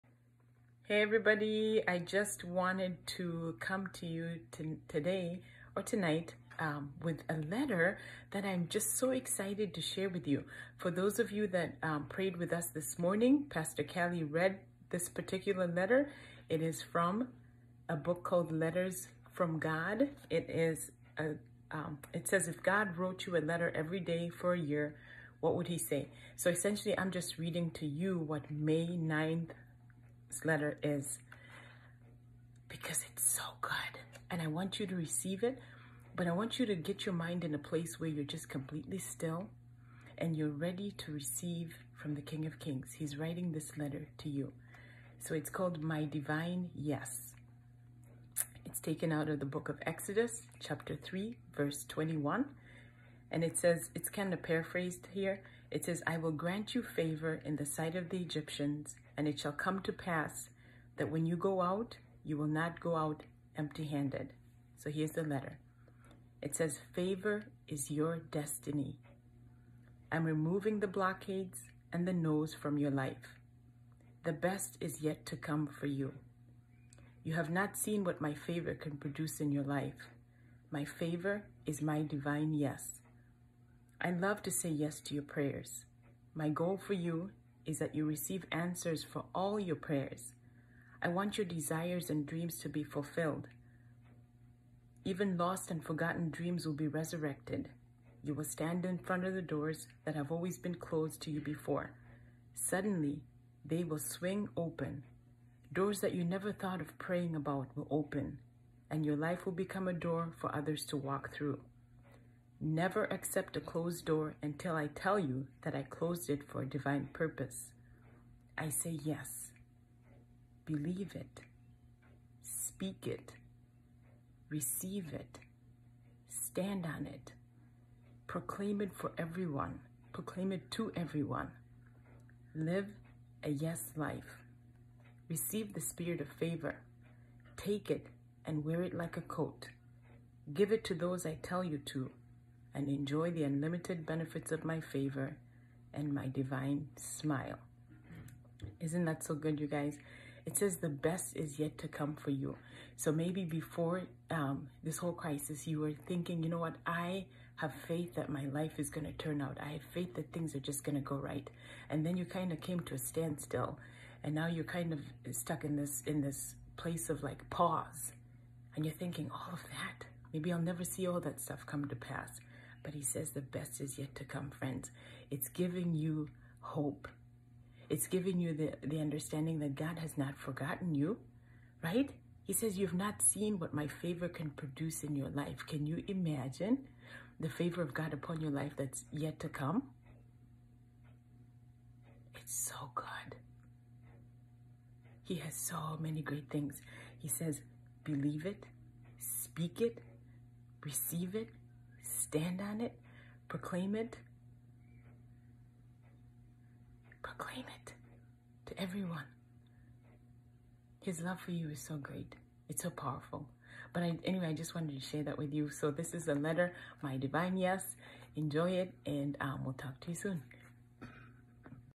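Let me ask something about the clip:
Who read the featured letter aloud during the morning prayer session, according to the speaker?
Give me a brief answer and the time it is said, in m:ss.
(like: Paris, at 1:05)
Pastor Kelly, at 0:13.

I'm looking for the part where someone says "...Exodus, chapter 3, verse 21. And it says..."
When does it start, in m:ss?
0:49.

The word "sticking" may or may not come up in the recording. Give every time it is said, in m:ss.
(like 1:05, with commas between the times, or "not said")
not said.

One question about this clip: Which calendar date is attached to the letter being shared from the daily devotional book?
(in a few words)
May 9.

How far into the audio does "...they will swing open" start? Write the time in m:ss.
1:43.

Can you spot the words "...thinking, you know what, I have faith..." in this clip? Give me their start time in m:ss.
2:36.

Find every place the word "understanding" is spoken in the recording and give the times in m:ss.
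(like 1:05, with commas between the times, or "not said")
2:58.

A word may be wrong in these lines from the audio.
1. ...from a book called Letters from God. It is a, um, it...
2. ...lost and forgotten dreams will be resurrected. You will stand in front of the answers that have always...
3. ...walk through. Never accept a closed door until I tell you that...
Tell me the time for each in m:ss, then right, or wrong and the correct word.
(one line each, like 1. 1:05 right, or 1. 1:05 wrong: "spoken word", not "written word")
1. 0:16 right
2. 1:35 wrong: "doors", not "answers"
3. 1:50 right.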